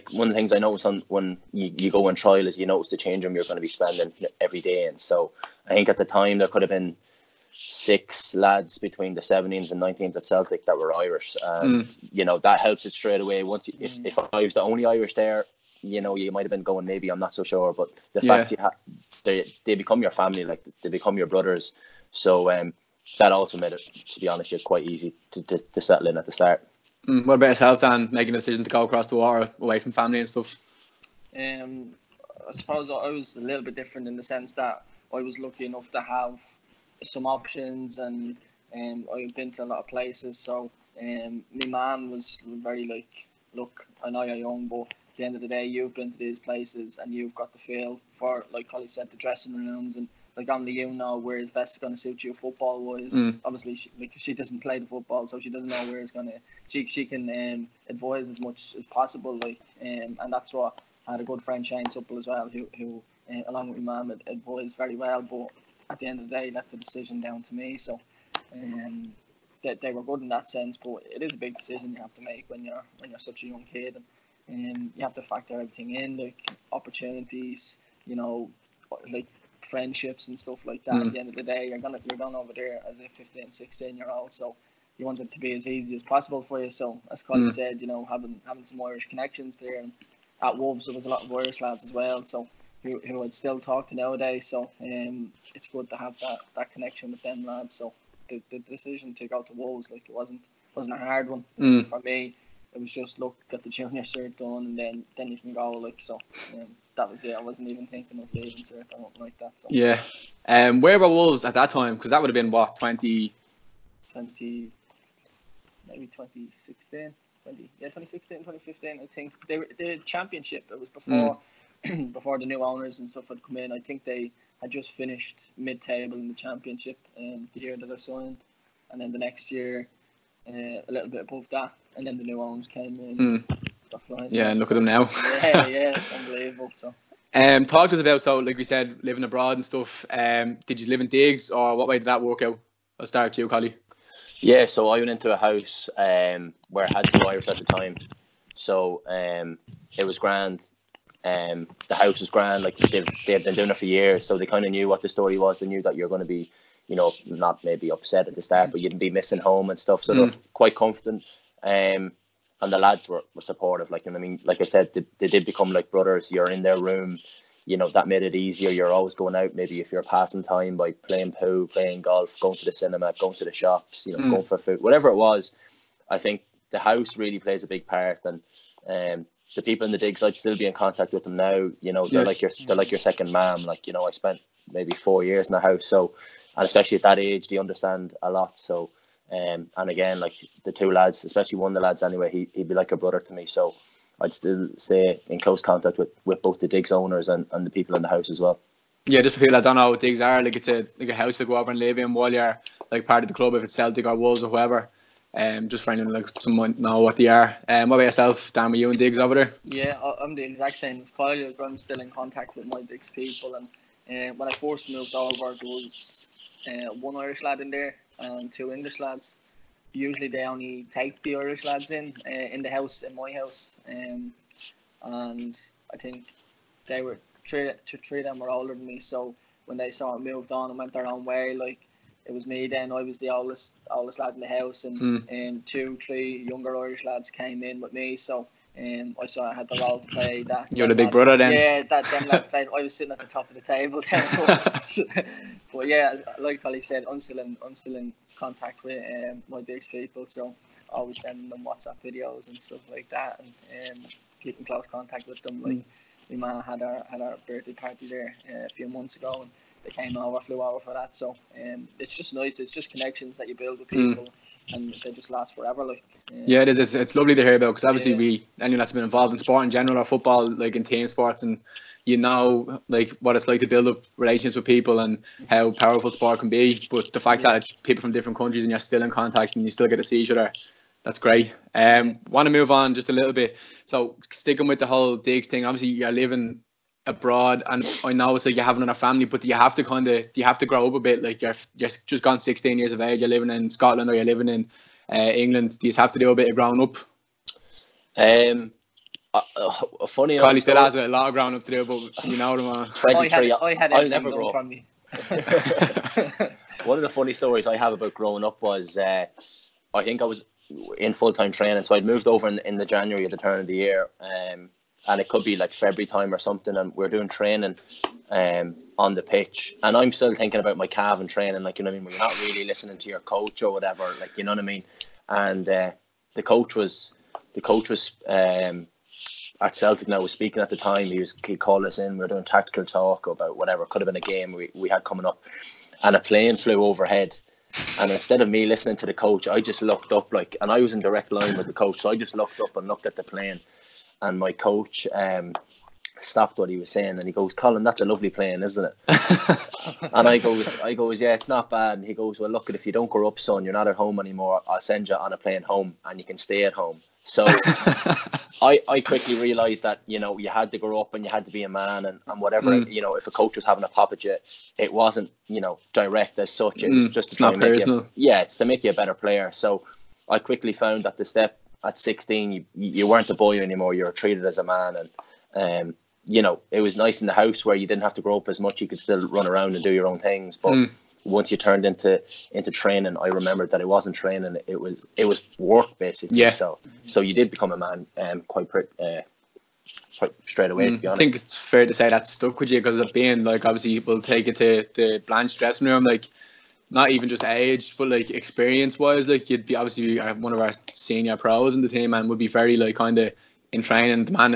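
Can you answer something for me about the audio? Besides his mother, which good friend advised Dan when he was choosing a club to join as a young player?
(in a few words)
Shane Supple.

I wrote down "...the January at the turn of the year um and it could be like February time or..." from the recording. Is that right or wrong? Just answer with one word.
right.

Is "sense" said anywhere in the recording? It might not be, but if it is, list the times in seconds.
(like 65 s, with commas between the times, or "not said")
34 s, 70 s.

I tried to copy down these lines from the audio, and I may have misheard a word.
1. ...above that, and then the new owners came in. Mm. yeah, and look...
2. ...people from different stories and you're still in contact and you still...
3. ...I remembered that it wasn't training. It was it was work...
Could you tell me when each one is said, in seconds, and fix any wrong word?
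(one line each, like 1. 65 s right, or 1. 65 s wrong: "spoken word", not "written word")
1. 131 s right
2. 277 s wrong: "countries", not "stories"
3. 383 s right.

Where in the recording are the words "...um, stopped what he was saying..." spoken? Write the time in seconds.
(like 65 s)
345 s.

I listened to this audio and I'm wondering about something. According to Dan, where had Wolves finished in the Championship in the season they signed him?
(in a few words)
Mid table.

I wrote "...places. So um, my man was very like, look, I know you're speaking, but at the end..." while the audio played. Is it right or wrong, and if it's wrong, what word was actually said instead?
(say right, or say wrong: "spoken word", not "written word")
wrong: "young", not "speaking".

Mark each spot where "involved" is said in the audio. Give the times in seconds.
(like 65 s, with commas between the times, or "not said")
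269 s.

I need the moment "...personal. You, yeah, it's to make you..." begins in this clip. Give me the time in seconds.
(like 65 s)
367 s.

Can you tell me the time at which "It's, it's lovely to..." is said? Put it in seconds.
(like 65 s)
266 s.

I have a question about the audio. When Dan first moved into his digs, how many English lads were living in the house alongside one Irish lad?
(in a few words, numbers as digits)
2.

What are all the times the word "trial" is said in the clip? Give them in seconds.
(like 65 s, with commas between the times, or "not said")
2 s.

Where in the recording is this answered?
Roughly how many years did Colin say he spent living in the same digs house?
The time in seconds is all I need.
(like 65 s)
184 s.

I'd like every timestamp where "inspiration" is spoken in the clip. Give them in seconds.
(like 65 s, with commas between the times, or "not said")
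not said.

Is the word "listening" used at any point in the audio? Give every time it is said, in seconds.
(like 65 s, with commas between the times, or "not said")
322 s, 338 s.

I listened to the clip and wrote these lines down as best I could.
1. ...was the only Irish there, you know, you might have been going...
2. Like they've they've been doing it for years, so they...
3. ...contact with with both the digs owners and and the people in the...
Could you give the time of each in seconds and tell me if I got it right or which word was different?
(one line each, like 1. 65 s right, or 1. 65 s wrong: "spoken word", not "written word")
1. 14 s right
2. 152 s right
3. 195 s right.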